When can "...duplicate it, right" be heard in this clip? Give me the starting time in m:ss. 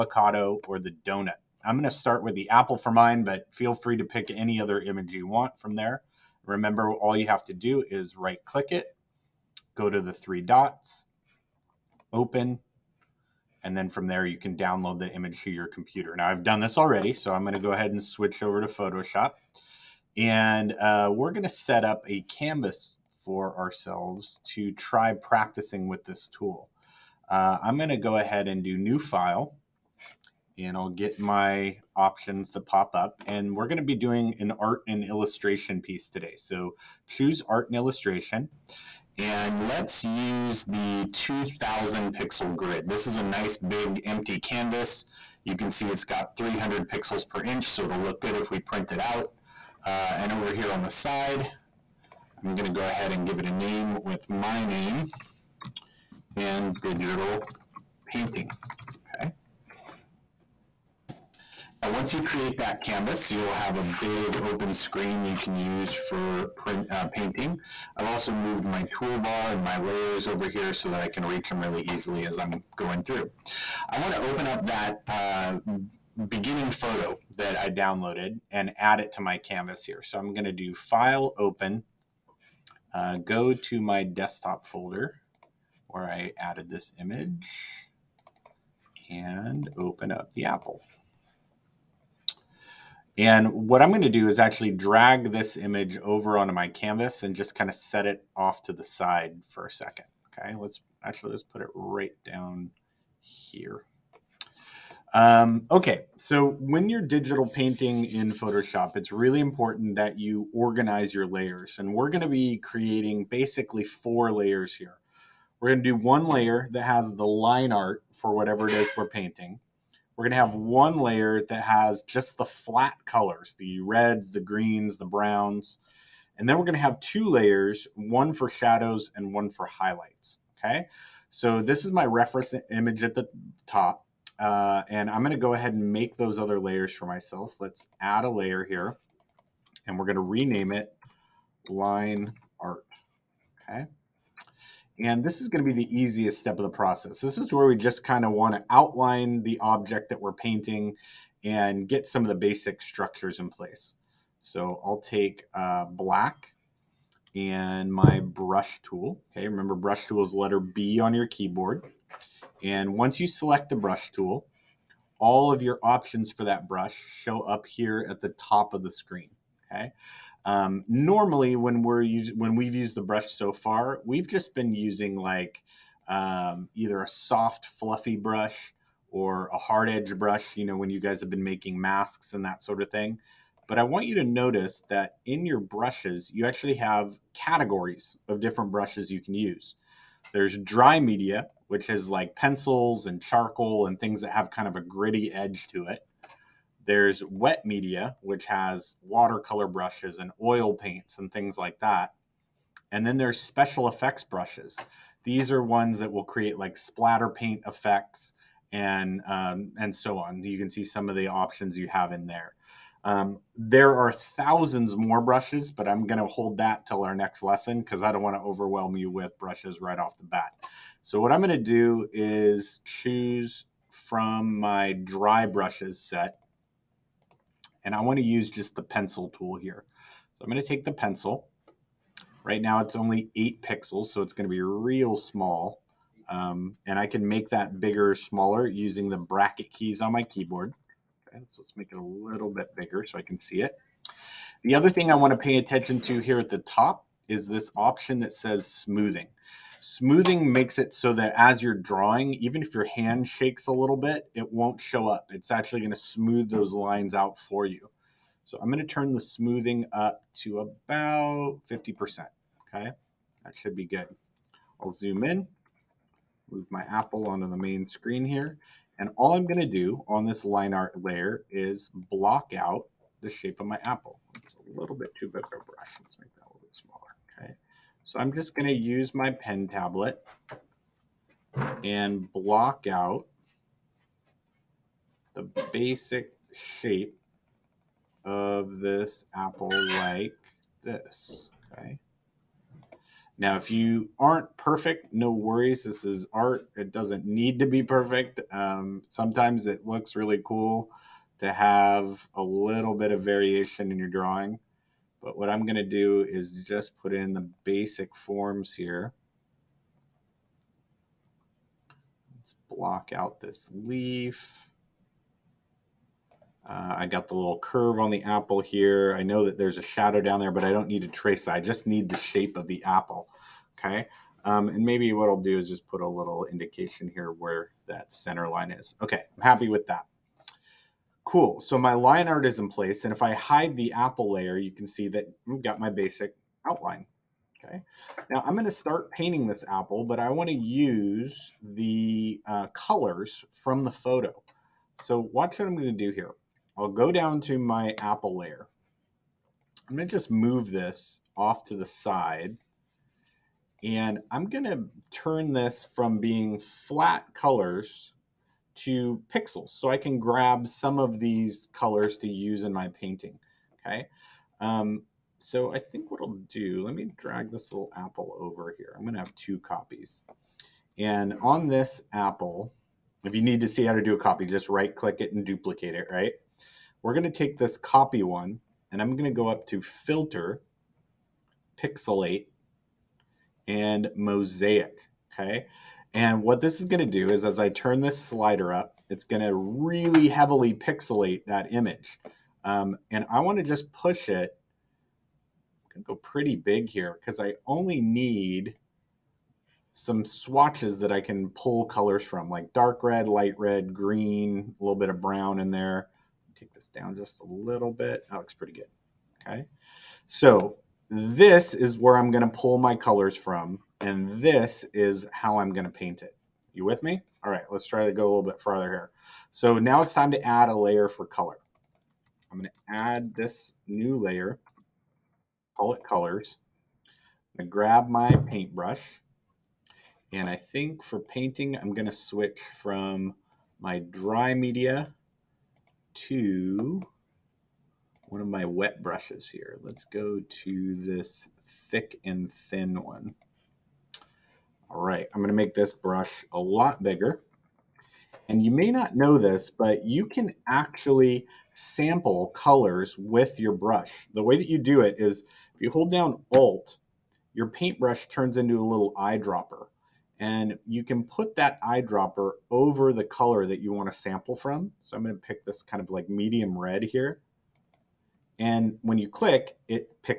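6:15.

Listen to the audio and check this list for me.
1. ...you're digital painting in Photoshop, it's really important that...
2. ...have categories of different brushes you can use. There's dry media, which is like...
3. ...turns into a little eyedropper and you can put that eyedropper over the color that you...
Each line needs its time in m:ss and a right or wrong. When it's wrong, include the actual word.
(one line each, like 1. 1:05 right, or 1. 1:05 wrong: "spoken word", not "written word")
1. 1:46 right
2. 3:06 right
3. 7:38 right.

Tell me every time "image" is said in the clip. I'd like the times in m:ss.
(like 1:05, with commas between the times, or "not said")
0:04, 0:15, 1:26, 1:35, 2:12, 6:31.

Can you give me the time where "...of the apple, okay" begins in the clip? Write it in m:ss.
5:22.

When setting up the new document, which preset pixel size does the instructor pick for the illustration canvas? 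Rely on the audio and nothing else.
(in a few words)
2000 pixel.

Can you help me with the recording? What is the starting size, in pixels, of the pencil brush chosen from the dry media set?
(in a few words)
8.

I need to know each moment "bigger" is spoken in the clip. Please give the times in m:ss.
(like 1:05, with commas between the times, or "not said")
3:57, 4:02, 7:27.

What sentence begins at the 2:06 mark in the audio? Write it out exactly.
And then we're going to have two layers, one for shadows and one for highlights.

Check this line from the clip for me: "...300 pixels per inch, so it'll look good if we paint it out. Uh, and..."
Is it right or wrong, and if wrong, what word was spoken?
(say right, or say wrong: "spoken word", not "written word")
wrong: "print", not "paint".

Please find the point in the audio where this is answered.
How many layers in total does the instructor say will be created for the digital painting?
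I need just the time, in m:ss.
1:53.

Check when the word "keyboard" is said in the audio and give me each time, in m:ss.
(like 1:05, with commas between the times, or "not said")
2:41, 4:00.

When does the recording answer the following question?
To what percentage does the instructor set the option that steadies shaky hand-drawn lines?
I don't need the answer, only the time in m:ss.
4:21.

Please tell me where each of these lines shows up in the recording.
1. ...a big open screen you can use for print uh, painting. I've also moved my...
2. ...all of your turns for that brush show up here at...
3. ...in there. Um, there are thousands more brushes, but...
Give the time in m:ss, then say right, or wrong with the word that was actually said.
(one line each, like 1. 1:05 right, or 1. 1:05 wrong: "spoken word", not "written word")
1. 1:03 right
2. 2:45 wrong: "options", not "turns"
3. 3:32 right.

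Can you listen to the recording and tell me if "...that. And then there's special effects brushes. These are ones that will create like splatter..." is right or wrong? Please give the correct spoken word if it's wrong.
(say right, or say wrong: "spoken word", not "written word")
right.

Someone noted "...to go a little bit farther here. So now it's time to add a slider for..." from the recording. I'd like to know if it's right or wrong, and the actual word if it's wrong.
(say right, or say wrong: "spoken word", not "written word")
wrong: "layer", not "slider".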